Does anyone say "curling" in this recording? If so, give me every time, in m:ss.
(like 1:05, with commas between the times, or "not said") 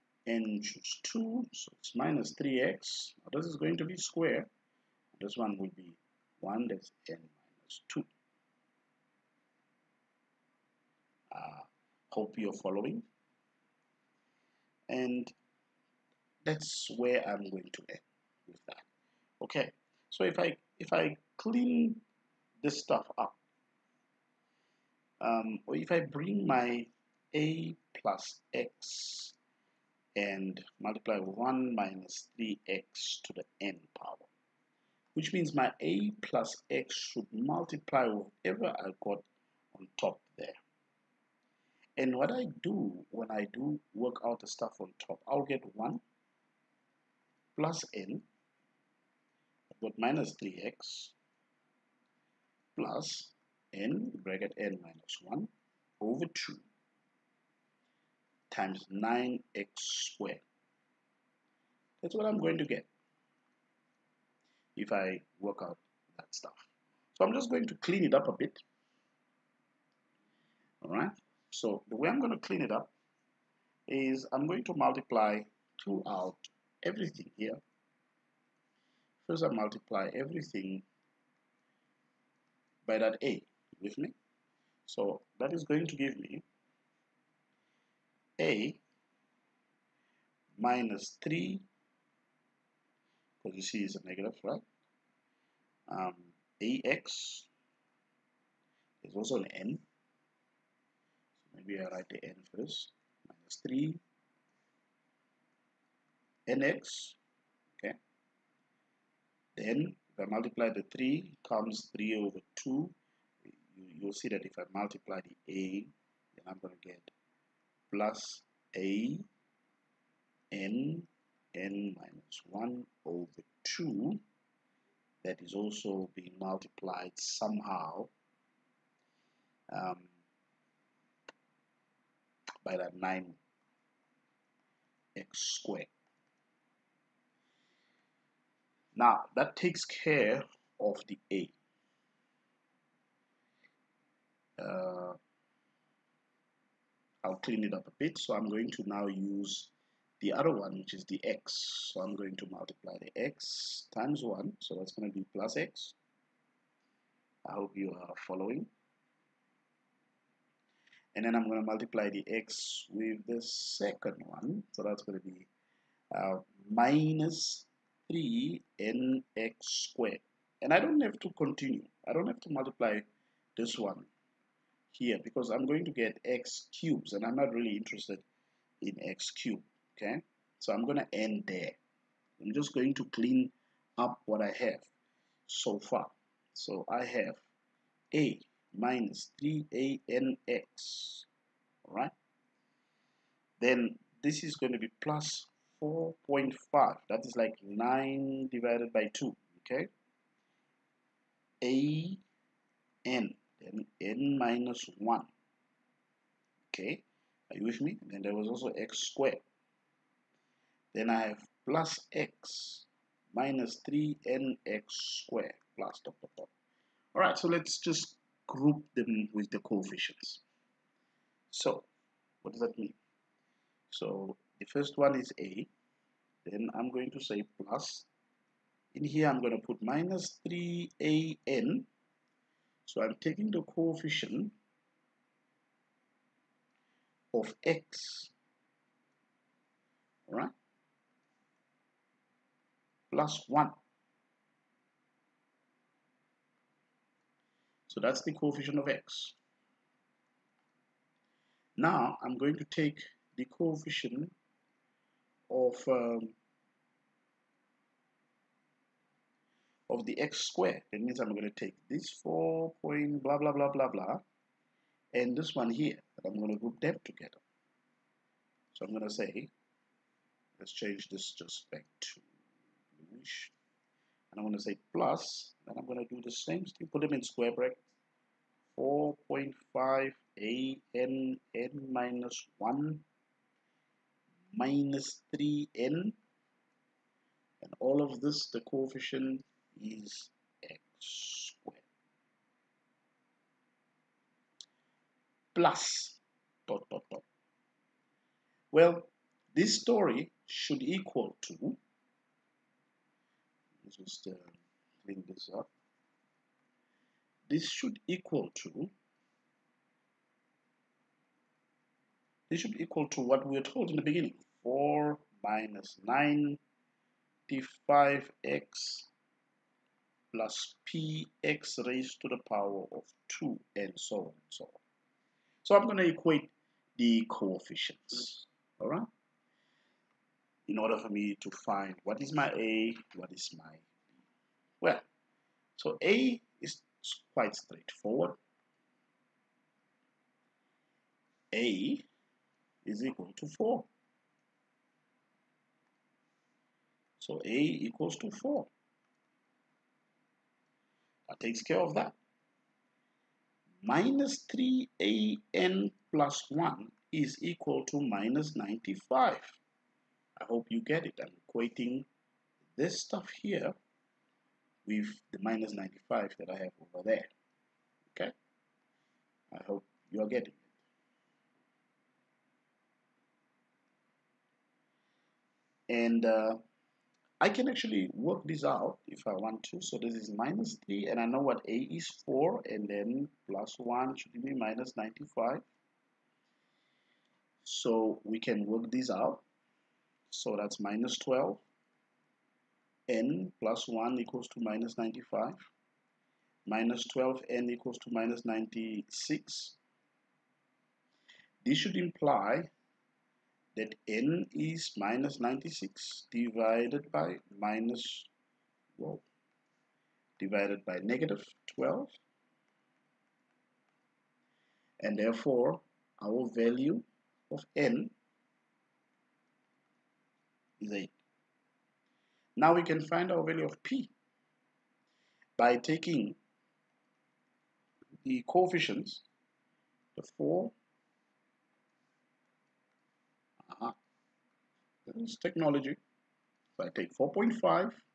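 not said.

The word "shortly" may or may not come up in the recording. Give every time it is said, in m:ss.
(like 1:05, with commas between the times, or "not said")
not said.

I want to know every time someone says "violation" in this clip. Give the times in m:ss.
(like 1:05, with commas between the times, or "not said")
not said.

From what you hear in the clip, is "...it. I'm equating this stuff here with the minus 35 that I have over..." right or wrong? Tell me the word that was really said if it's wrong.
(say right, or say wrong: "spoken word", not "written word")
wrong: "95", not "35".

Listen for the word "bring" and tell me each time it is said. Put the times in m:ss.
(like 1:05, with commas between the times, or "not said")
0:25.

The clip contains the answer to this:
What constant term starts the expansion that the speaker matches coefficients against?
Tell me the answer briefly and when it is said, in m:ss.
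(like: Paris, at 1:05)
4, at 5:14.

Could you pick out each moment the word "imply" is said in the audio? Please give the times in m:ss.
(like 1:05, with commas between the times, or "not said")
6:41.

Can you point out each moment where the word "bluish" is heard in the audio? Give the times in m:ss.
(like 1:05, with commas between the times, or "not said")
4:33.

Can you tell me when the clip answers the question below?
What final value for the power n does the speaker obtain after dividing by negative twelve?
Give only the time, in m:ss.
7:00.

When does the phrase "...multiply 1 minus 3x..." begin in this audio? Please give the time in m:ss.
0:30.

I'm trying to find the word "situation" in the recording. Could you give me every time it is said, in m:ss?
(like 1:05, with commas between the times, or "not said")
not said.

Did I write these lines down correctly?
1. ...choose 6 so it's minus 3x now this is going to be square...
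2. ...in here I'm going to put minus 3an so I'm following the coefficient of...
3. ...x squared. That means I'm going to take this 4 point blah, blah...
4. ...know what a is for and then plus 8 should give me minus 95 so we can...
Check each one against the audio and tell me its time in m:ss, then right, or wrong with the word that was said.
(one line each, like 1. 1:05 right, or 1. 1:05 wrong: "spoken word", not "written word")
1. 0:00 wrong: "2", not "6"
2. 3:48 wrong: "taking", not "following"
3. 4:20 right
4. 6:21 wrong: "1", not "8".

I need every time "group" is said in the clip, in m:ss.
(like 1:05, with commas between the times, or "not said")
3:38, 4:26.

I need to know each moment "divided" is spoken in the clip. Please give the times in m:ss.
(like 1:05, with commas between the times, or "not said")
3:18, 6:46, 6:50.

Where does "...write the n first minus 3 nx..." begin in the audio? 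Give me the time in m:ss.
1:41.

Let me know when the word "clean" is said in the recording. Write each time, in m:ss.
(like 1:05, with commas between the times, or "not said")
0:21, 1:07, 1:12, 2:27, 3:03, 5:05.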